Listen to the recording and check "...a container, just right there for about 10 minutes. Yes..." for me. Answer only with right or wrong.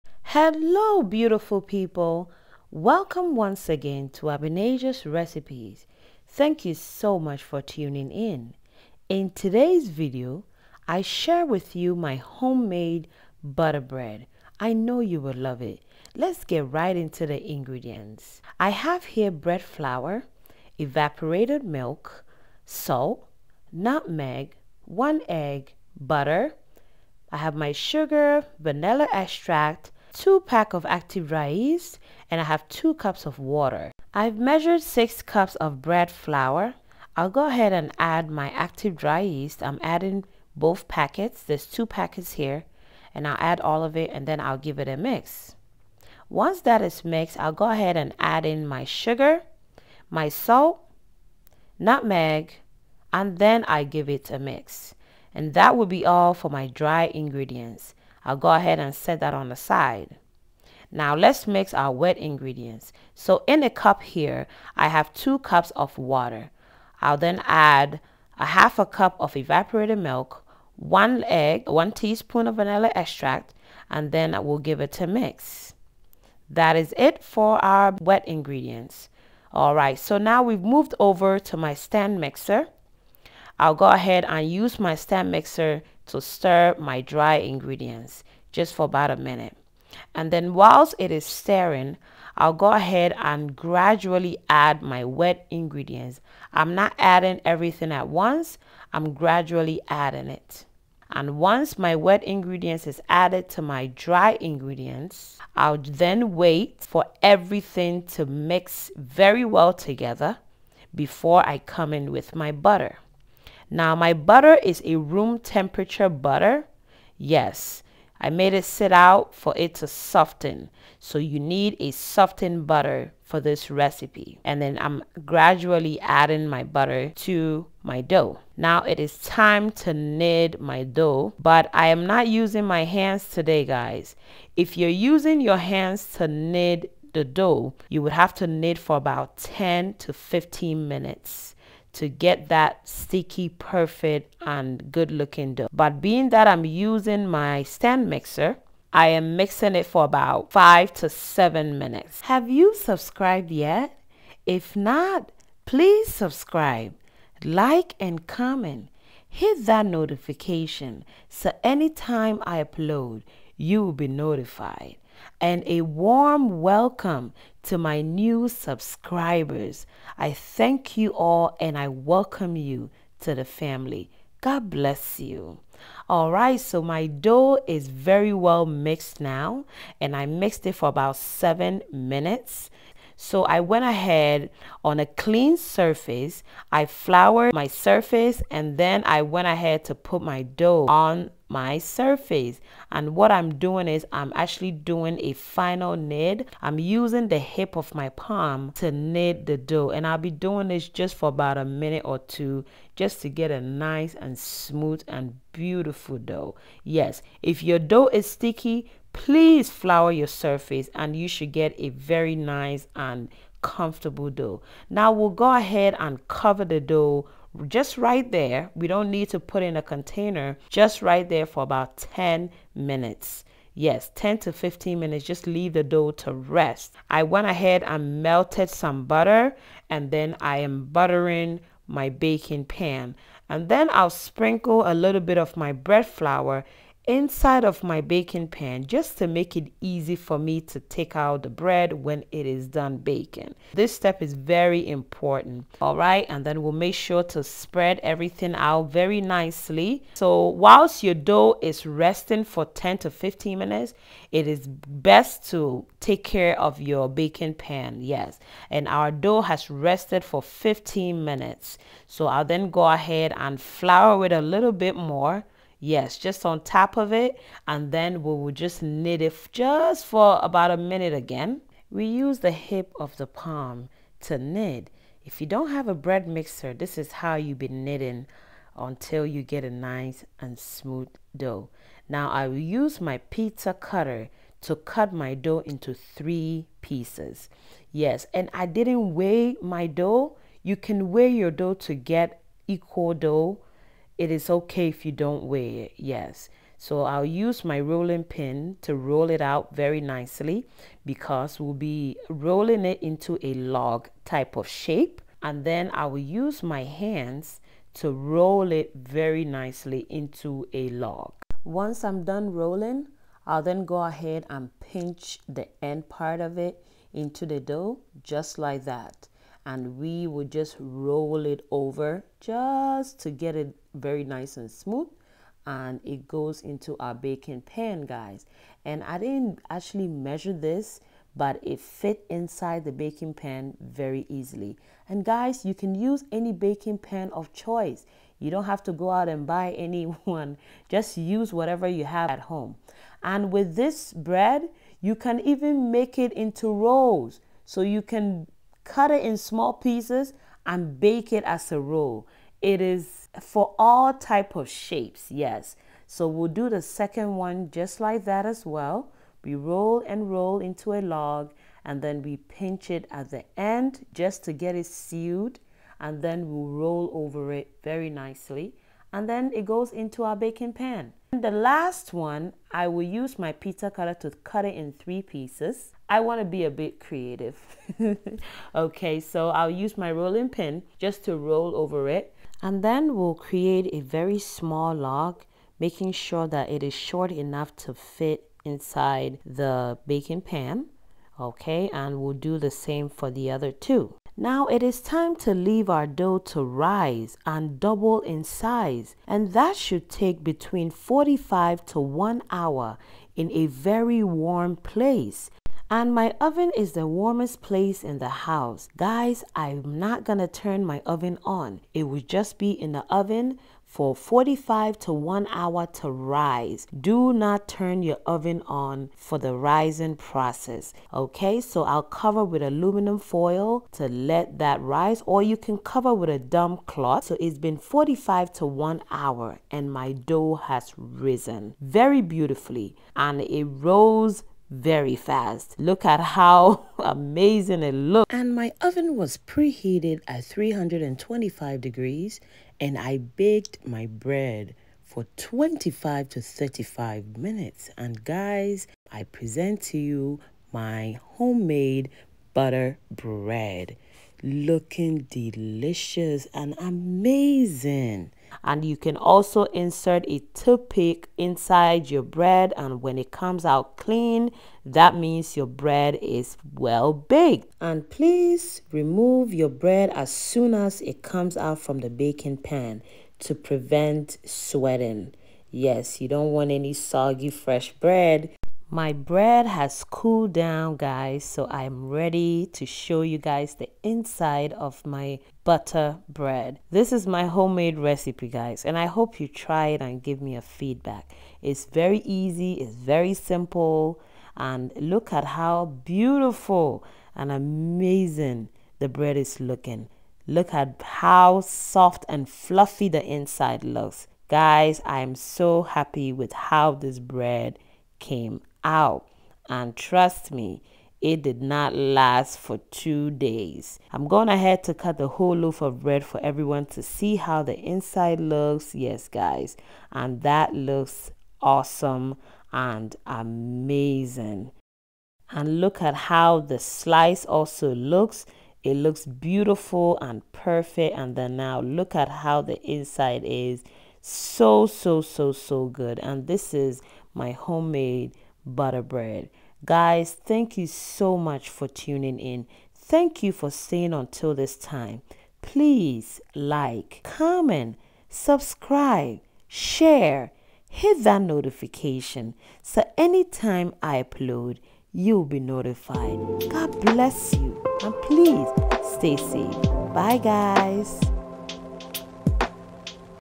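right.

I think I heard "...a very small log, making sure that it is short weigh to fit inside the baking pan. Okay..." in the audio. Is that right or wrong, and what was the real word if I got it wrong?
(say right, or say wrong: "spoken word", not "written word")
wrong: "enough", not "weigh".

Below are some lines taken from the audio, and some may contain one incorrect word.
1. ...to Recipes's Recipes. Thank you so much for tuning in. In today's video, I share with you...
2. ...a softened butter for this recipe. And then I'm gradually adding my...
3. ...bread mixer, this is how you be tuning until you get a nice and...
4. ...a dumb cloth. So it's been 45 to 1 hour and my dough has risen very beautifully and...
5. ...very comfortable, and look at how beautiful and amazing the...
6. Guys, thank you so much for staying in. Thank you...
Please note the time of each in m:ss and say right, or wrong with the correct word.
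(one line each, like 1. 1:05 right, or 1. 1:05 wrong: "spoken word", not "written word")
1. 0:04 wrong: "Abenasia", not "Recipes"
2. 2:01 right
3. 4:35 wrong: "knitting", not "tuning"
4. 7:06 right
5. 8:12 wrong: "simple", not "comfortable"
6. 8:59 wrong: "tuning", not "staying".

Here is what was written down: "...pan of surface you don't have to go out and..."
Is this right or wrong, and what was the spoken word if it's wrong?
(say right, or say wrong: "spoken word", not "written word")
wrong: "choice", not "surface".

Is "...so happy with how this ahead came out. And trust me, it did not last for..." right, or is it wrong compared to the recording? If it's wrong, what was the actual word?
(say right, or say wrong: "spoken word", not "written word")
wrong: "bread", not "ahead".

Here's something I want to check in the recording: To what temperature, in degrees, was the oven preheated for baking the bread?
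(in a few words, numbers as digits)
325.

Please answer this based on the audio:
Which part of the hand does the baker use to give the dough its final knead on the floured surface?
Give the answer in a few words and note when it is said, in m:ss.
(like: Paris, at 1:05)
the hip of my palm, at 3:17.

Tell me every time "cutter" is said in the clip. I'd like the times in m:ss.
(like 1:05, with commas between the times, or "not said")
4:43, 6:13.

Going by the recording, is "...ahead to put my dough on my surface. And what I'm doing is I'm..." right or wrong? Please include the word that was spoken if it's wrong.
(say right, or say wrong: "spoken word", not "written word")
right.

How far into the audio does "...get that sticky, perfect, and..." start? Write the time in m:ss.
2:22.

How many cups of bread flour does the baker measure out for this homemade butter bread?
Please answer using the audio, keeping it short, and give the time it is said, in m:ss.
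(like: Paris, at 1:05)
6 cups, at 0:34.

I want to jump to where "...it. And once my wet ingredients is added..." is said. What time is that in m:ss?
1:40.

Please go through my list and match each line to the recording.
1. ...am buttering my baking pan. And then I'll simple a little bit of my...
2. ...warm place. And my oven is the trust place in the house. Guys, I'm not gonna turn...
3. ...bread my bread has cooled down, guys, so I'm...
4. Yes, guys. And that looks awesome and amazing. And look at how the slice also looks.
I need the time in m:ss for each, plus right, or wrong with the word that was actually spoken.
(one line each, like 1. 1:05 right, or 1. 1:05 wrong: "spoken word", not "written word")
1. 3:50 wrong: "sprinkle", not "simple"
2. 6:44 wrong: "warmest", not "trust"
3. 7:57 right
4. 8:38 right.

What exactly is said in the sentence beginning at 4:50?
You can weigh your dough to get equal dough it is okay if you don't weigh it, yes.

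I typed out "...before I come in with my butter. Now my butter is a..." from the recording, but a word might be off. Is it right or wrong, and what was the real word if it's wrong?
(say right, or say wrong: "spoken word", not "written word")
right.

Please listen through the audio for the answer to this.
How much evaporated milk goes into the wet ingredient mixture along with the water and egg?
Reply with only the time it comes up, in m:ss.
1:08.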